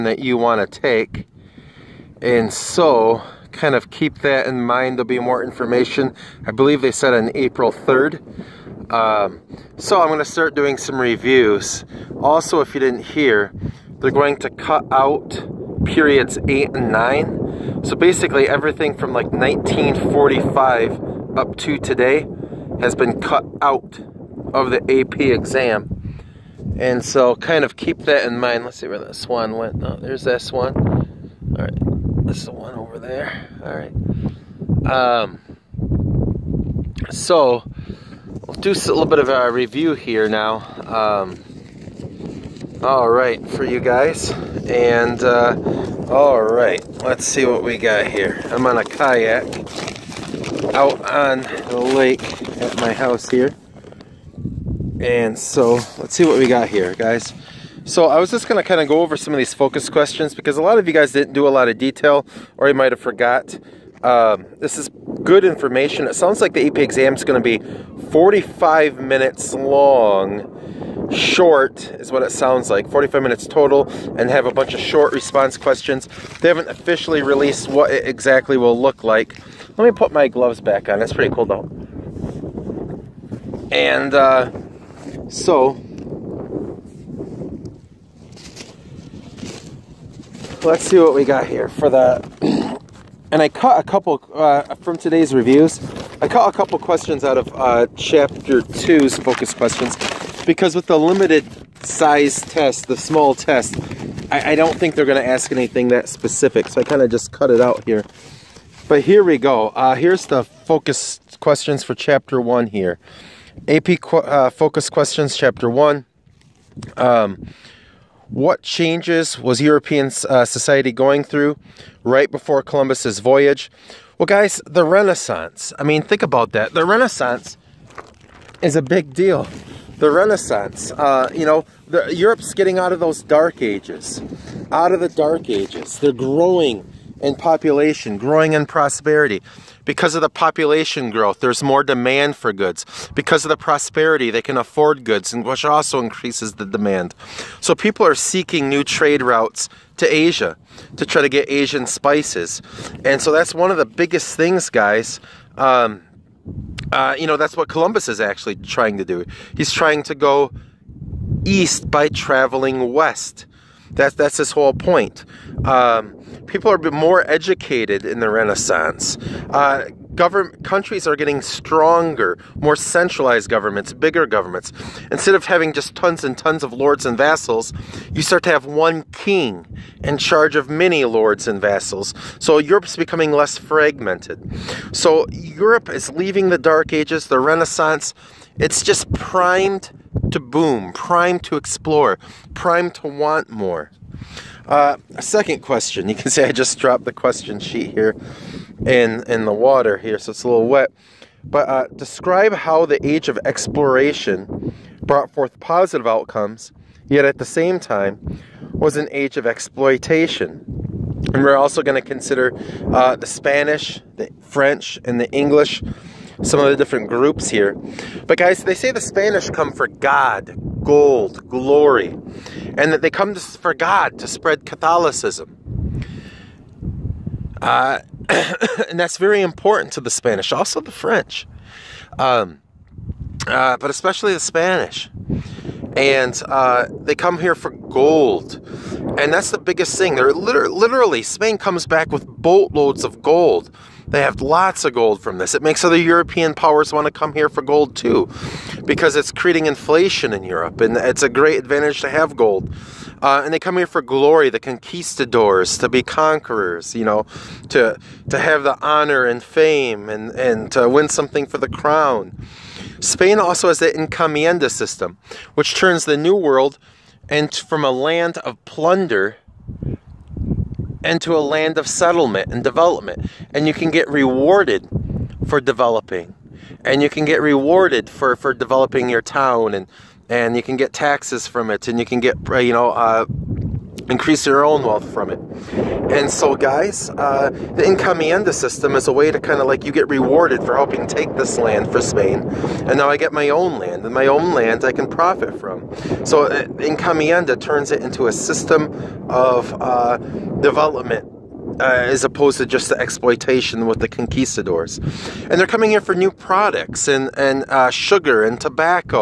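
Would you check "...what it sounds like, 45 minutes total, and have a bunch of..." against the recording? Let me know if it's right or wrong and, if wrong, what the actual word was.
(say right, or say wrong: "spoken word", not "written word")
right.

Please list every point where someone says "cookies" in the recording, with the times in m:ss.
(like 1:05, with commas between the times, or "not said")
not said.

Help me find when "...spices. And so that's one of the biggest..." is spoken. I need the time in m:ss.
2:31.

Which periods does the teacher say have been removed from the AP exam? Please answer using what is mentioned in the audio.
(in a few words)
8 and 9.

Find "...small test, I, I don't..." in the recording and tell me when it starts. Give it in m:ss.
1:42.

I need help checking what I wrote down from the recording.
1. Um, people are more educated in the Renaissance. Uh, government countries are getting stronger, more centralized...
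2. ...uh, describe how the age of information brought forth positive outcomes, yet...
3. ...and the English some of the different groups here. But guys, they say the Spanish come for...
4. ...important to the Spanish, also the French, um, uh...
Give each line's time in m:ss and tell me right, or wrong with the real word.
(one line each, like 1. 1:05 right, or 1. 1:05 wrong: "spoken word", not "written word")
1. 2:45 right
2. 3:21 wrong: "exploration", not "information"
3. 3:35 right
4. 3:49 right.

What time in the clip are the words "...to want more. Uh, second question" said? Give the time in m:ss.
3:12.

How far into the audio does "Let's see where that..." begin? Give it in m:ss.
0:28.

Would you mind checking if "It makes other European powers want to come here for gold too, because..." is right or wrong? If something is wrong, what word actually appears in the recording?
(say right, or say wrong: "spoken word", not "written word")
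right.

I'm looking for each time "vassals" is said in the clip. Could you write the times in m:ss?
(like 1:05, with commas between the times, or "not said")
2:57, 3:01.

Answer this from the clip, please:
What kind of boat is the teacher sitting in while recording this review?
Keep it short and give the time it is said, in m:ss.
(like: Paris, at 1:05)
a kayak, at 0:48.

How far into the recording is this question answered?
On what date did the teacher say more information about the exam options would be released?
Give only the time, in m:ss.
0:07.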